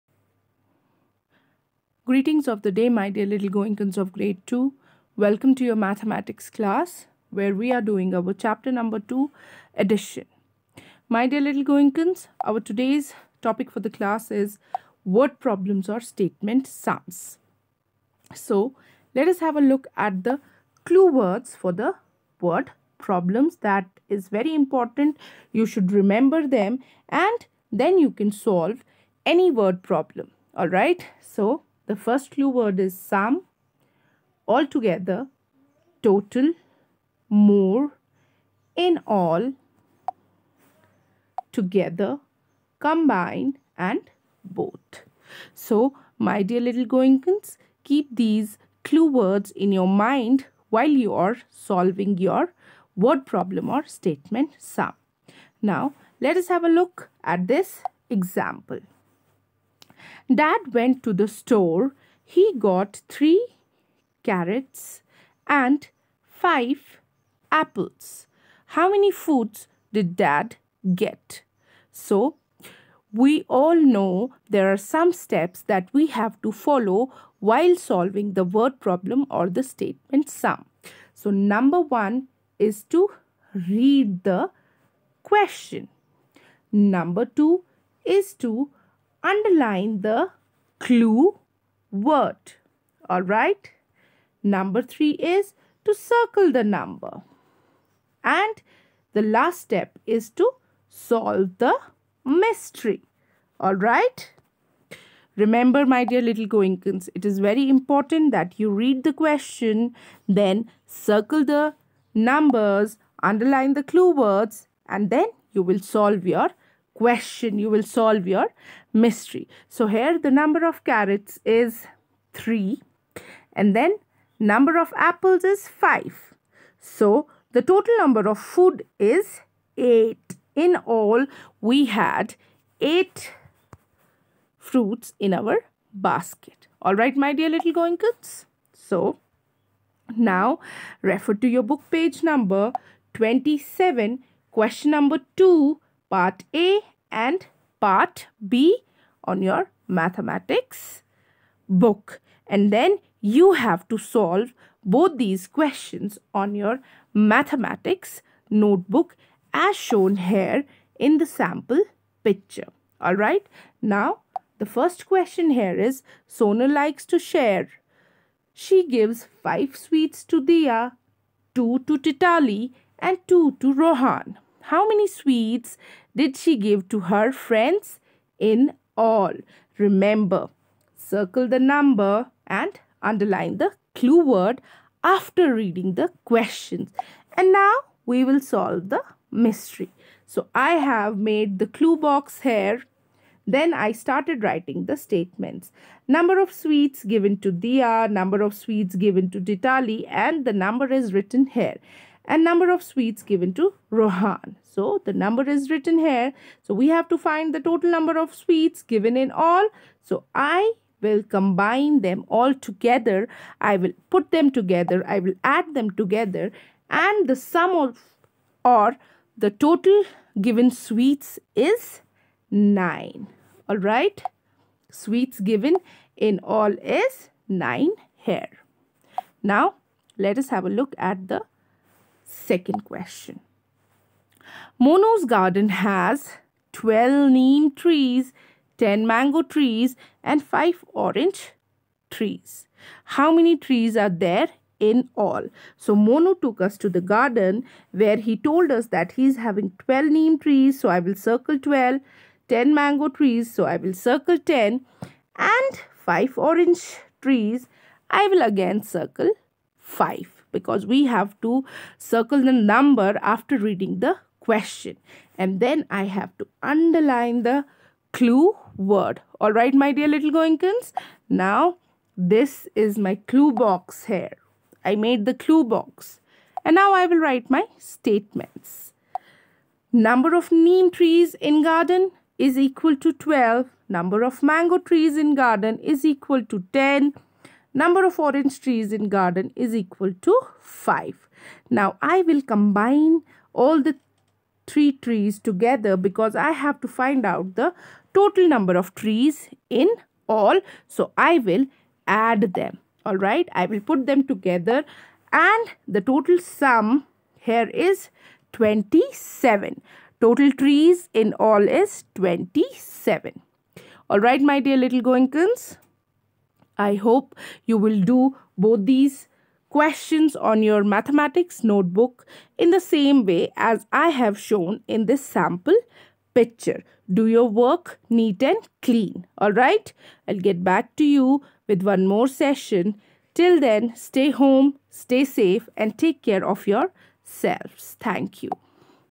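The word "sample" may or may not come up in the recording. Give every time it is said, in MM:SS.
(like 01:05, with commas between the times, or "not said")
02:41, 05:25.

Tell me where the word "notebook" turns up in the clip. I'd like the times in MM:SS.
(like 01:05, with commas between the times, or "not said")
02:38, 05:21.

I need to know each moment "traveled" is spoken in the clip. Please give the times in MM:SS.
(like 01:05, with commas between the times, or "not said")
not said.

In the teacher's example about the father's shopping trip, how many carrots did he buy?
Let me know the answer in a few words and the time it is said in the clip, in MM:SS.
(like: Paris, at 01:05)
3, at 01:03.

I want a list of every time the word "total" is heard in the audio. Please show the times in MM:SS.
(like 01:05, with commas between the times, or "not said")
00:36, 02:07, 03:27, 03:39, 04:58, 05:06, 05:10.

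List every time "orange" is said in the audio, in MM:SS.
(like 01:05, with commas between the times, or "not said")
04:00, 04:16, 04:48.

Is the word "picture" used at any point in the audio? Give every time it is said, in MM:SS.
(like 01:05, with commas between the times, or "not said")
02:42, 05:26.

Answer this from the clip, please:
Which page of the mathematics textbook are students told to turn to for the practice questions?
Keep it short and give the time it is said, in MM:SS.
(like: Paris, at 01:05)
27, at 02:21.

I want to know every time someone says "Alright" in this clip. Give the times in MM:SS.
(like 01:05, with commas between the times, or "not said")
01:33, 01:43, 02:16, 03:43, 05:03, 05:14.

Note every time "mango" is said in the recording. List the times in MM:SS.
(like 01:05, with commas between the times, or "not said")
03:59, 04:12, 04:44.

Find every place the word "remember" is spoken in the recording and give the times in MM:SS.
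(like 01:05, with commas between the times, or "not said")
00:25, 01:45, 02:59.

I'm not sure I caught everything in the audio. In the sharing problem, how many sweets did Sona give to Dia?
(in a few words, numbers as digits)
5.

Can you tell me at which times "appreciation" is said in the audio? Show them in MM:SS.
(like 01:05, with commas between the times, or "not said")
not said.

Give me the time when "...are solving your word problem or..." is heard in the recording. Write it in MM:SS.
00:51.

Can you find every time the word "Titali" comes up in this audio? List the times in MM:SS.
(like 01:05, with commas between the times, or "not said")
02:51.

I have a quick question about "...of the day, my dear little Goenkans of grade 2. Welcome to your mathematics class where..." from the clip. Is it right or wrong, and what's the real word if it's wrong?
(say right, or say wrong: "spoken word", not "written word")
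right.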